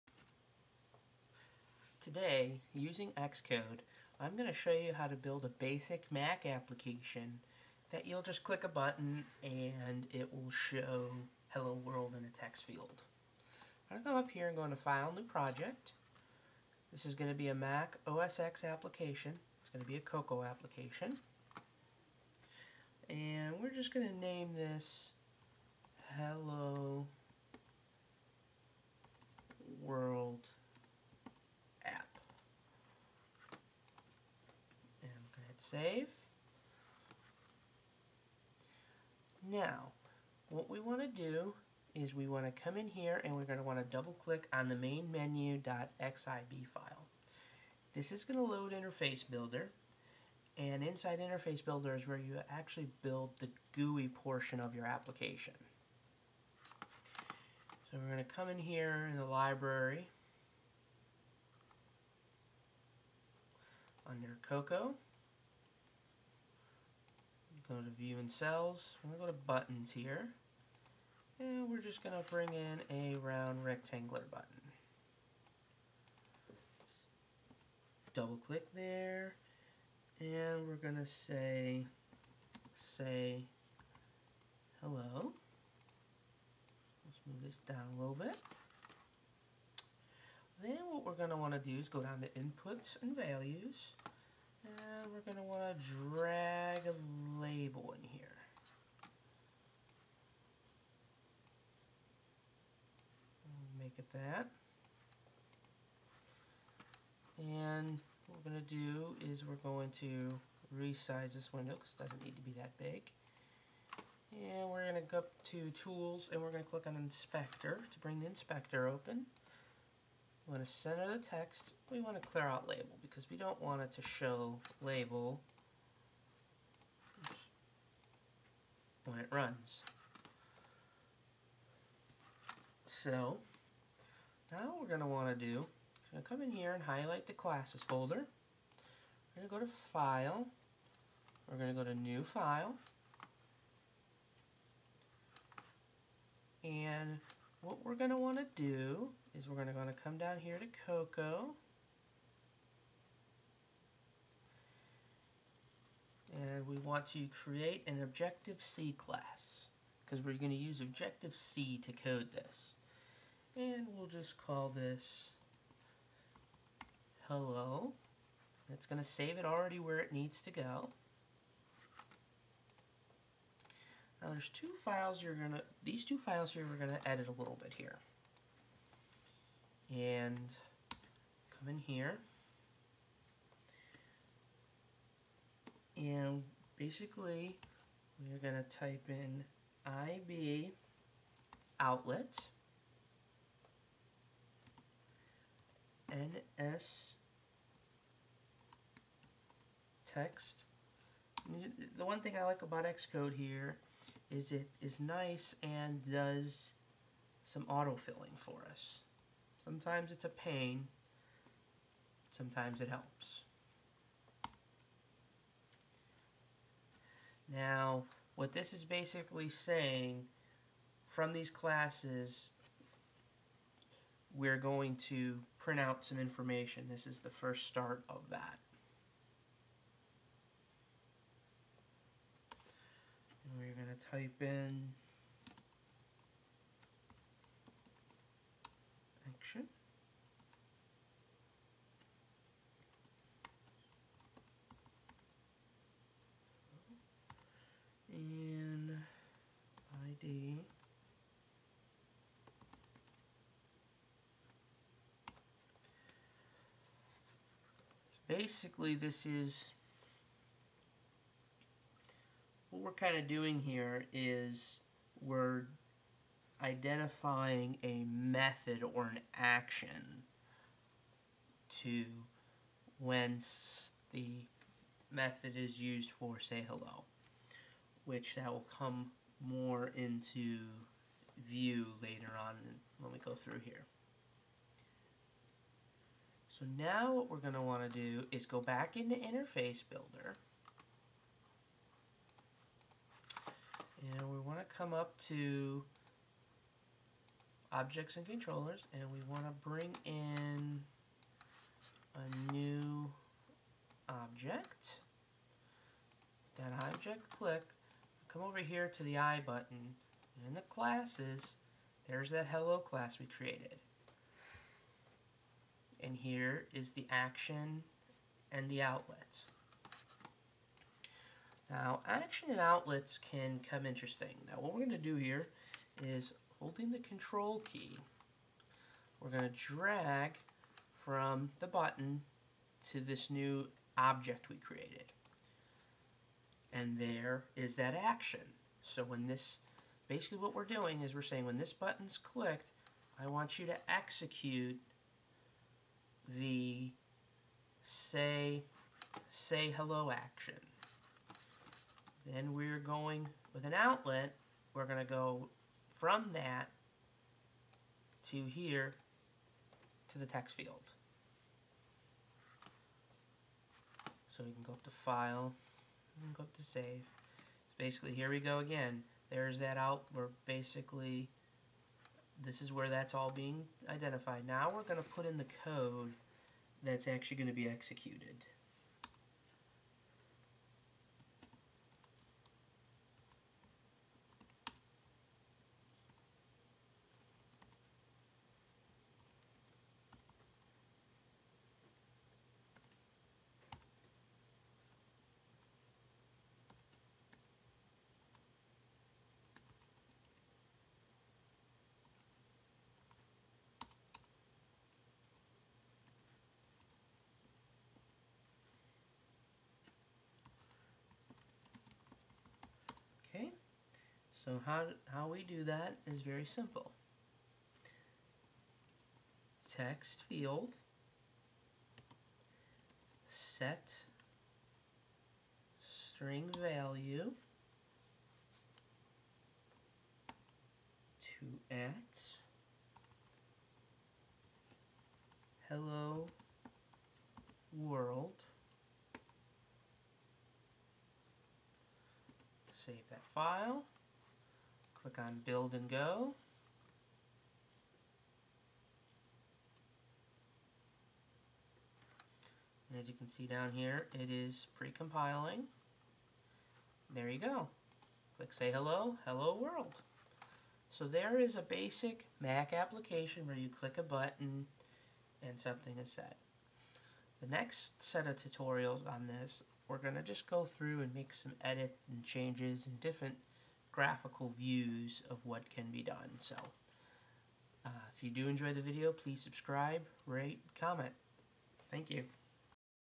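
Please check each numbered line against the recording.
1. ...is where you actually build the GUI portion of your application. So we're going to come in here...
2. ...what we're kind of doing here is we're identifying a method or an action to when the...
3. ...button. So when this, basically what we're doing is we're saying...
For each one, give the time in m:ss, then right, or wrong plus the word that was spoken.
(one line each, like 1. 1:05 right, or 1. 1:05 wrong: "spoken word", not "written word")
1. 0:51 right
2. 4:22 right
3. 5:38 wrong: "action", not "button".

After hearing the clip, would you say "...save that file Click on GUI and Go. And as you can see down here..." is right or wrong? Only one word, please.
wrong.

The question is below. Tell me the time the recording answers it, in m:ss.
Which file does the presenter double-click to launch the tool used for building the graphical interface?
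0:44.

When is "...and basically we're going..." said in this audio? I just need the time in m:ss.
3:05.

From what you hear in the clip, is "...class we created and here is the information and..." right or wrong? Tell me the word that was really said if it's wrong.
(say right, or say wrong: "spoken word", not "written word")
wrong: "action", not "information".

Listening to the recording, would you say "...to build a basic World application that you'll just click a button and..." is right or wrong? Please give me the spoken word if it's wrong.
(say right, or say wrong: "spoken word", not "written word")
wrong: "Mac", not "World".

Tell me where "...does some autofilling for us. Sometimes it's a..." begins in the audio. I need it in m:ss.
3:26.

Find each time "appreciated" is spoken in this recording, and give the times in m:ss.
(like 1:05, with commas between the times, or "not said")
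not said.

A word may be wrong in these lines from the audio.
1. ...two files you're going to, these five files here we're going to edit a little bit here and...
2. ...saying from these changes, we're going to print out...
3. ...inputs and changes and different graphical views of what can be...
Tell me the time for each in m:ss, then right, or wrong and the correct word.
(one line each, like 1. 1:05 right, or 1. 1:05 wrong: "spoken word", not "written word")
1. 2:54 wrong: "two", not "five"
2. 3:39 wrong: "classes", not "changes"
3. 7:51 wrong: "edits", not "inputs".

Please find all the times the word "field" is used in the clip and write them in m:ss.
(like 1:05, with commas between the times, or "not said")
0:12, 6:00, 7:00.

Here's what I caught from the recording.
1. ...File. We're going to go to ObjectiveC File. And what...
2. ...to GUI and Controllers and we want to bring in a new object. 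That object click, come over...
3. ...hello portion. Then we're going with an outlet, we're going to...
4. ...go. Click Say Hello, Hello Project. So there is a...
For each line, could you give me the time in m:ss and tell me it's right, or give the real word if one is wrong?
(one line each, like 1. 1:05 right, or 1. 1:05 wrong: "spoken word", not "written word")
1. 2:19 wrong: "New", not "ObjectiveC"
2. 4:55 wrong: "Objects", not "GUI"
3. 5:49 wrong: "action", not "portion"
4. 7:37 wrong: "World", not "Project".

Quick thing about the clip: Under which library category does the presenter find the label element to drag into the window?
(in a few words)
inputs and values.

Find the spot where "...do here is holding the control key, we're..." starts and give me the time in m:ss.
5:24.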